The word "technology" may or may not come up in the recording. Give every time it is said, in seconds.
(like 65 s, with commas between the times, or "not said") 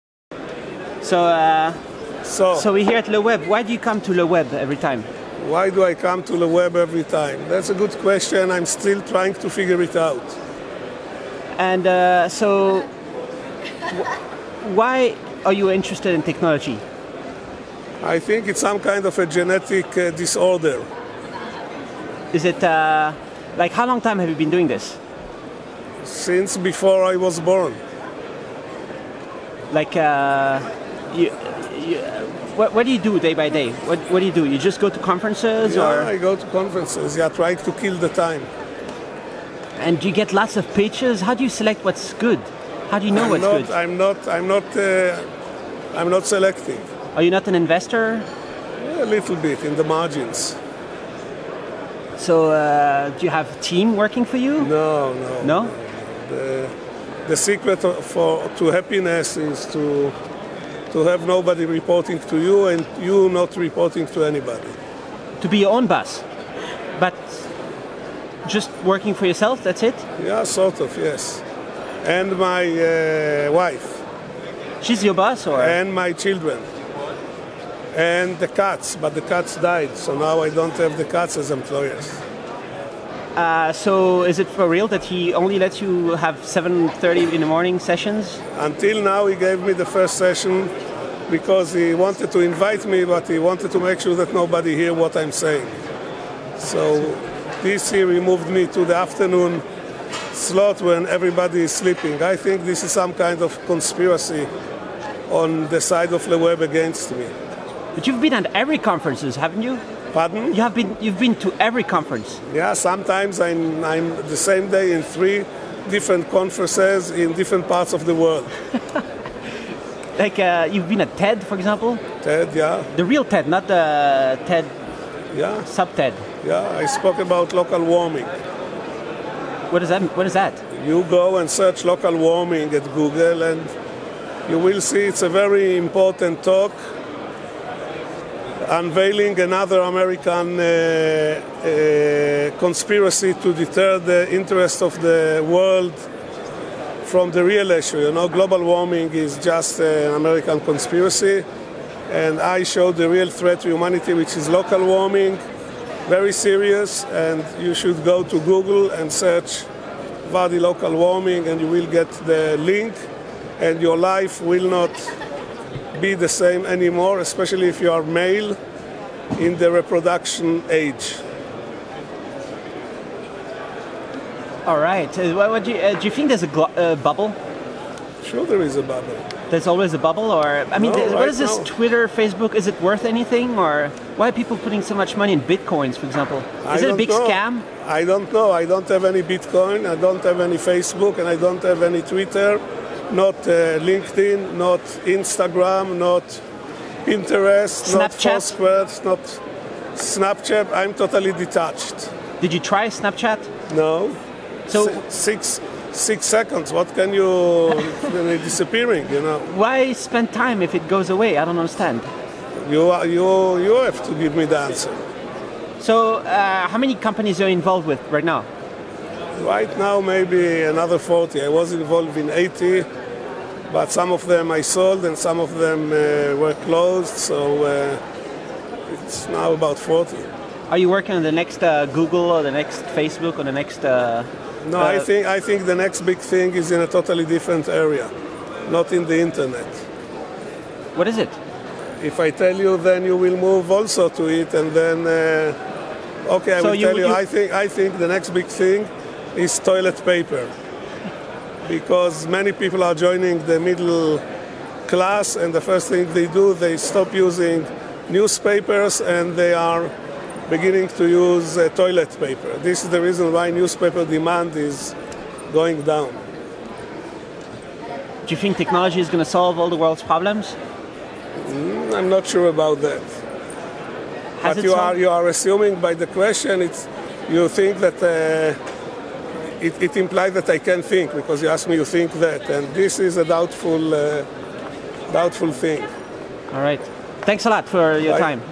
16 s, 268 s.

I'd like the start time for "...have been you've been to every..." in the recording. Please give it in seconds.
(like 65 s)
110 s.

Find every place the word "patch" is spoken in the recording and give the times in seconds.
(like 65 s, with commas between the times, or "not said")
not said.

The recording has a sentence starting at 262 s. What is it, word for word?
This is the reason why newspaper demand is going down.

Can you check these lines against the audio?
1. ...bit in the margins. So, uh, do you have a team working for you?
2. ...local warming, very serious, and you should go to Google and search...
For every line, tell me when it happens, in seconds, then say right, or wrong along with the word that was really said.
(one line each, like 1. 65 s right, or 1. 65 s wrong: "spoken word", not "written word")
1. 49 s right
2. 154 s right.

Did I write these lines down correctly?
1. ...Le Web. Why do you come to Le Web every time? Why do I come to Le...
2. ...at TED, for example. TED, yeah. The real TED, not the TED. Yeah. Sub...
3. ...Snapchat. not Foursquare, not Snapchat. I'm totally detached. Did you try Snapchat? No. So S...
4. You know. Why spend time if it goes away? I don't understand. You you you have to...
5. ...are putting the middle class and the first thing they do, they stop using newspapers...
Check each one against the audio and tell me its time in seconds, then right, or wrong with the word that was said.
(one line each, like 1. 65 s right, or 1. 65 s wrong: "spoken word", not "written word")
1. 3 s right
2. 121 s right
3. 197 s right
4. 209 s right
5. 252 s wrong: "joining", not "putting".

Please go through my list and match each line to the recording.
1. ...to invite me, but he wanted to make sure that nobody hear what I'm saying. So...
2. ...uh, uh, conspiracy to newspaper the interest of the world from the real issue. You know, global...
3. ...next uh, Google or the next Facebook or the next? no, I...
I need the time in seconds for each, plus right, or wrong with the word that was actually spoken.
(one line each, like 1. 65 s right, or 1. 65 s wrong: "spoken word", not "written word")
1. 92 s right
2. 140 s wrong: "deter", not "newspaper"
3. 231 s right.